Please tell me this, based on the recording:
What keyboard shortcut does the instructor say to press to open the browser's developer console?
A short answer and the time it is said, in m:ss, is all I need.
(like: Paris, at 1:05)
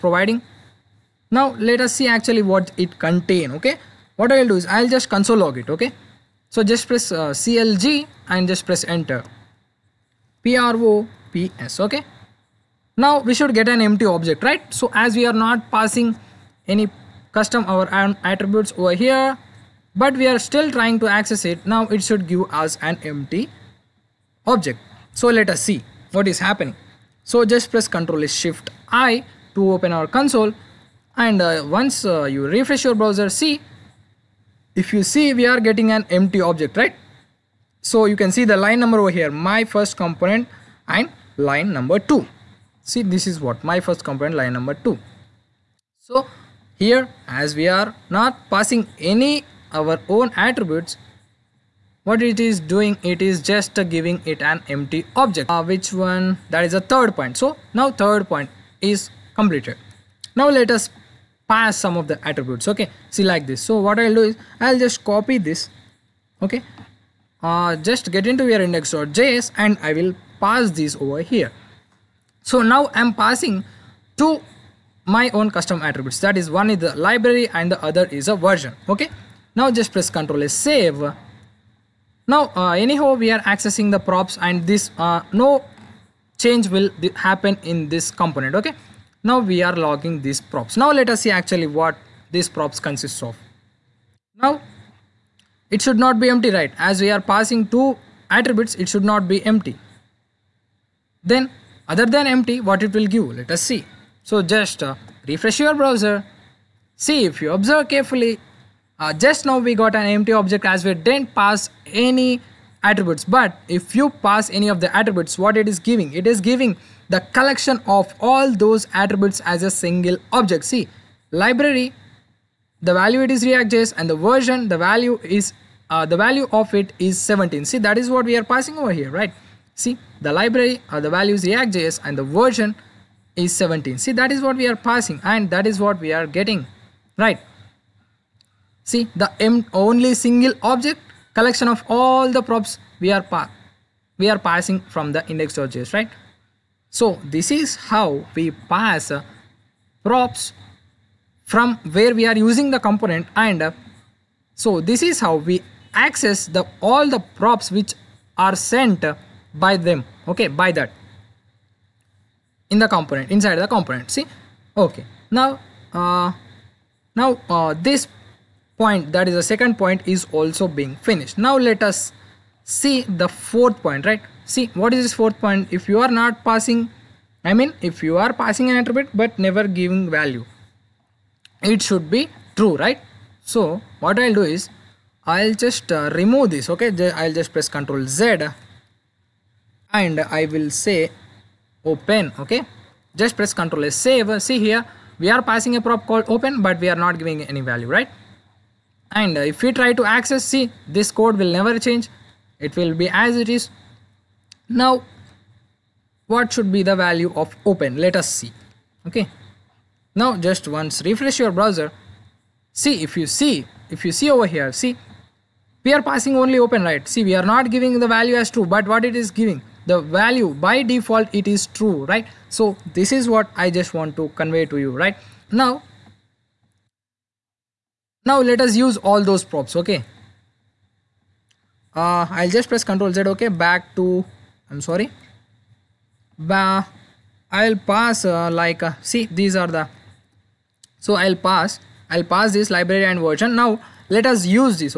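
Ctrl Shift I, at 0:27.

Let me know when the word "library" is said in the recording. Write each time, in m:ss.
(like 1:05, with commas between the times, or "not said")
1:17, 2:01, 2:10, 4:02.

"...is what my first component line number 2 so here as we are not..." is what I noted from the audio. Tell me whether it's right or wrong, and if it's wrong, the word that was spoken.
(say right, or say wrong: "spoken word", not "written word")
right.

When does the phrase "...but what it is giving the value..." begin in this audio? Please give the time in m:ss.
3:38.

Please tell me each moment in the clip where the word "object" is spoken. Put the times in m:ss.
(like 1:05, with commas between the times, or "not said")
0:14, 0:24, 0:36, 0:55, 1:50, 2:00, 2:20.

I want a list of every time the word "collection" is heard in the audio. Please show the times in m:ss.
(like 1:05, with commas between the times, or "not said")
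1:57, 2:21.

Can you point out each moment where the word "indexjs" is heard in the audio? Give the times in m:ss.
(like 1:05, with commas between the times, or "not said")
1:08, 2:25.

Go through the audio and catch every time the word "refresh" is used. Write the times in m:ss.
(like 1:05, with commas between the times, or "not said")
0:32, 1:45, 3:31.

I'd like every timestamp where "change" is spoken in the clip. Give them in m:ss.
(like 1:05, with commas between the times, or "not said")
1:26, 3:21.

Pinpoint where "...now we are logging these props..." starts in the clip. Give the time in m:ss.
1:29.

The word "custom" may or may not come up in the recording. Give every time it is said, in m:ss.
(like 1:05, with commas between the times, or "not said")
0:17, 1:15.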